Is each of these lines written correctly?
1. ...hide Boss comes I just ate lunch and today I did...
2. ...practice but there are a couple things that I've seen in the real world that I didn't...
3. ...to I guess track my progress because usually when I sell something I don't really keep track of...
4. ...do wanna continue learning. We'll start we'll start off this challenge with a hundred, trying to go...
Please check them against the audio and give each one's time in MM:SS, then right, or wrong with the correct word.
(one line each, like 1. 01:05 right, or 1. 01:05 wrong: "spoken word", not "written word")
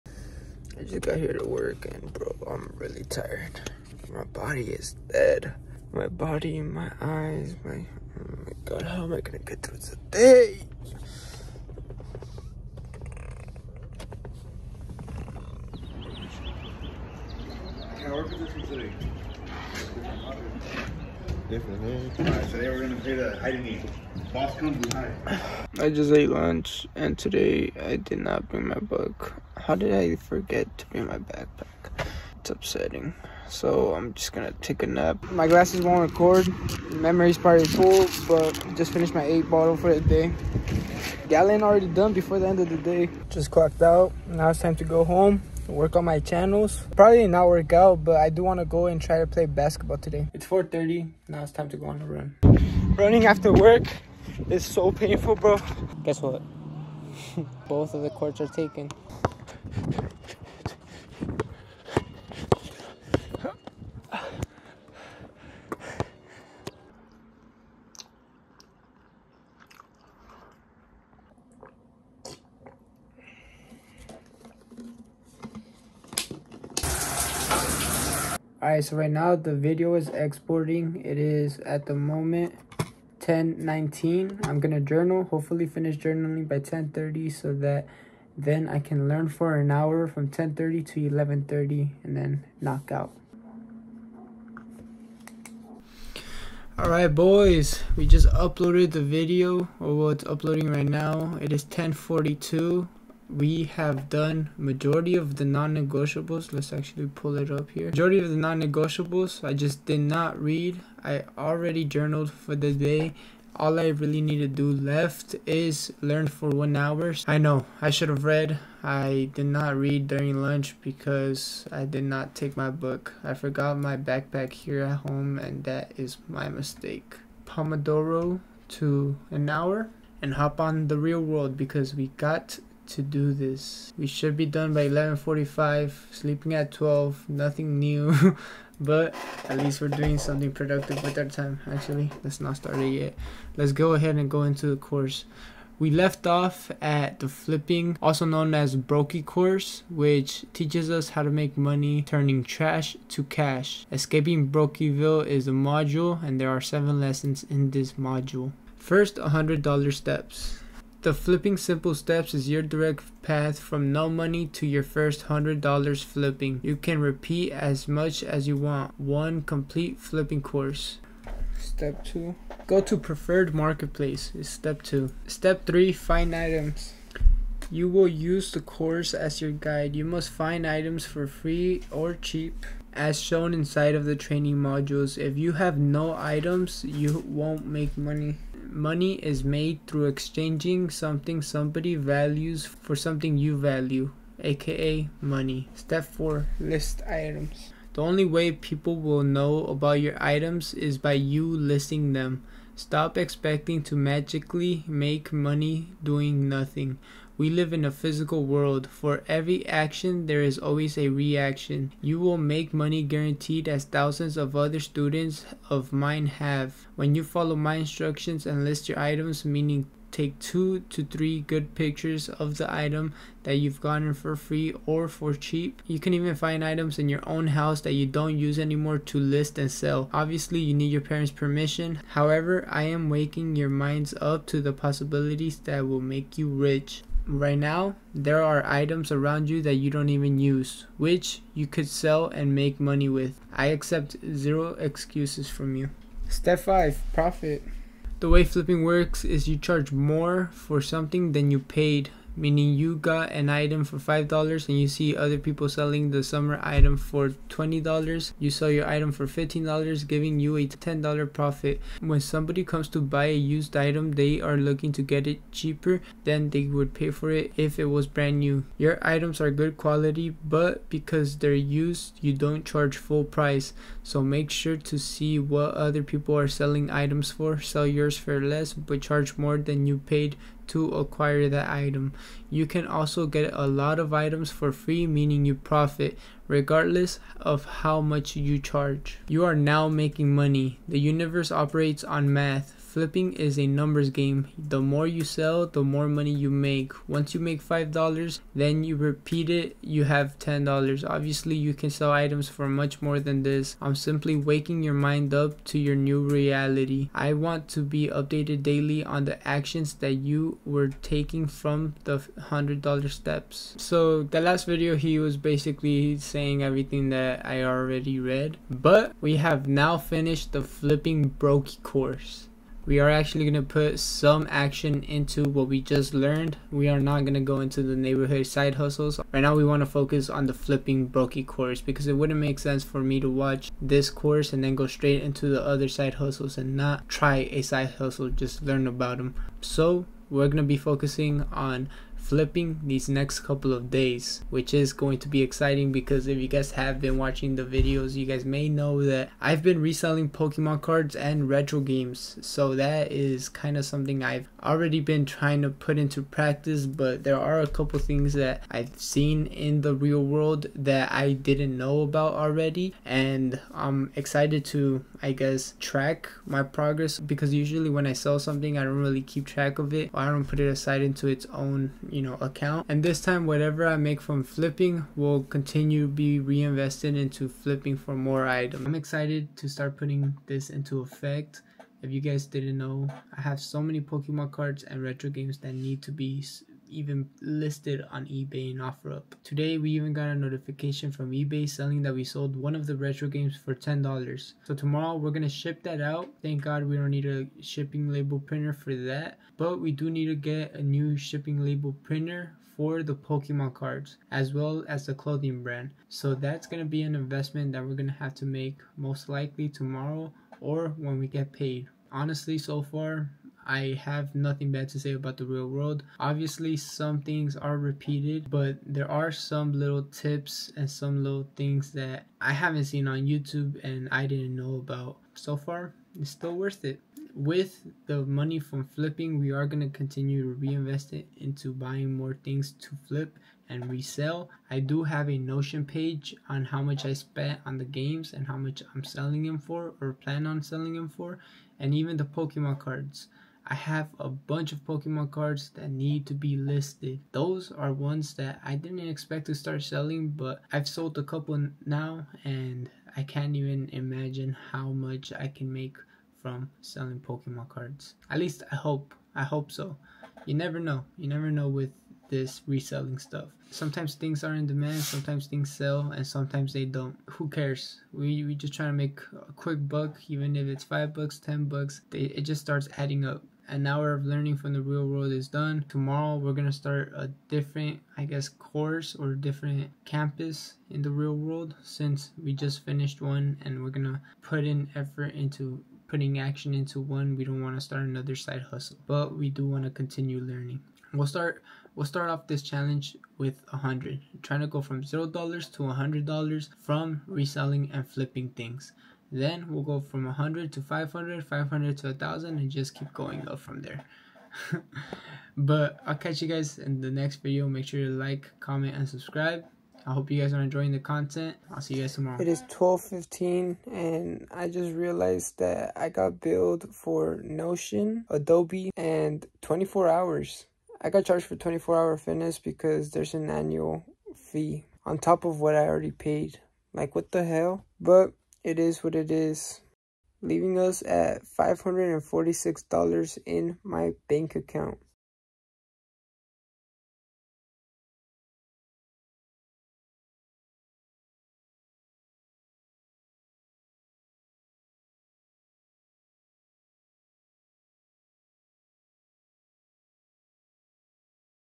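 1. 00:23 right
2. 05:56 right
3. 06:04 right
4. 08:09 right.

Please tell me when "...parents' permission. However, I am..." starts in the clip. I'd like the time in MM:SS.
03:51.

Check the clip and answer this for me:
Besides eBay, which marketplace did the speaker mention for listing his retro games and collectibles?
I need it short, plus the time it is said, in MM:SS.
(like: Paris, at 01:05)
OfferUp, at 06:28.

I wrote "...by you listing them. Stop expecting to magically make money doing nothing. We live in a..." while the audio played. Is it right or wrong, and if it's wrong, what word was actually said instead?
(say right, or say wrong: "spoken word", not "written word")
right.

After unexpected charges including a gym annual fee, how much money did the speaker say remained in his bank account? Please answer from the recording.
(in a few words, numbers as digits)
$546.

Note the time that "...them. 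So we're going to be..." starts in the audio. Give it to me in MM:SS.
05:39.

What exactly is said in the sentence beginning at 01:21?
It is at the moment 10:19.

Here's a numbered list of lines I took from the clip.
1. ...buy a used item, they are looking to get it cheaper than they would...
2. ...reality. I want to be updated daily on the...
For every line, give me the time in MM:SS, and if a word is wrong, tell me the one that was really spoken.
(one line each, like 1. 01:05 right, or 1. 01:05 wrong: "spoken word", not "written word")
1. 04:23 right
2. 05:06 right.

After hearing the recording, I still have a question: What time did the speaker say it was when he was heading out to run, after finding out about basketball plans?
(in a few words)
4:30.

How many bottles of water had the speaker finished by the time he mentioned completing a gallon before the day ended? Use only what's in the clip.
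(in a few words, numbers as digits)
8.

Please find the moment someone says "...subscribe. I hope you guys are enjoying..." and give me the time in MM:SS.
08:29.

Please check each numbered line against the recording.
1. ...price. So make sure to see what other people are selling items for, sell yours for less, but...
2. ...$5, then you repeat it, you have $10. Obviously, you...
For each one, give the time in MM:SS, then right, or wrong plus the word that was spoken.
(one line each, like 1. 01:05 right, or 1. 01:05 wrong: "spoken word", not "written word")
1. 04:33 right
2. 04:57 right.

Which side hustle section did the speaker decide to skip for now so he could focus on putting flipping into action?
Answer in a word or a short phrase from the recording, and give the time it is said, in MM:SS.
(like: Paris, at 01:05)
neighborhood side hustles, at 05:27.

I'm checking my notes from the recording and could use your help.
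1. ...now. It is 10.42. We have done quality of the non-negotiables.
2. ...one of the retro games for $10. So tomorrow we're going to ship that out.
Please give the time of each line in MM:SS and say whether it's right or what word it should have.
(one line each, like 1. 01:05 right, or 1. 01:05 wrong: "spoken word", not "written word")
1. 01:40 wrong: "majority", not "quality"
2. 06:32 right.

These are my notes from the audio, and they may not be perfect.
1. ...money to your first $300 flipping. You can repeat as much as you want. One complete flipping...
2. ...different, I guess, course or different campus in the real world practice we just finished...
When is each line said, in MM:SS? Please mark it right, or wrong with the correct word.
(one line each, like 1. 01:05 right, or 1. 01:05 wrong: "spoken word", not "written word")
1. 02:44 wrong: "100", not "300"
2. 07:57 wrong: "since", not "practice".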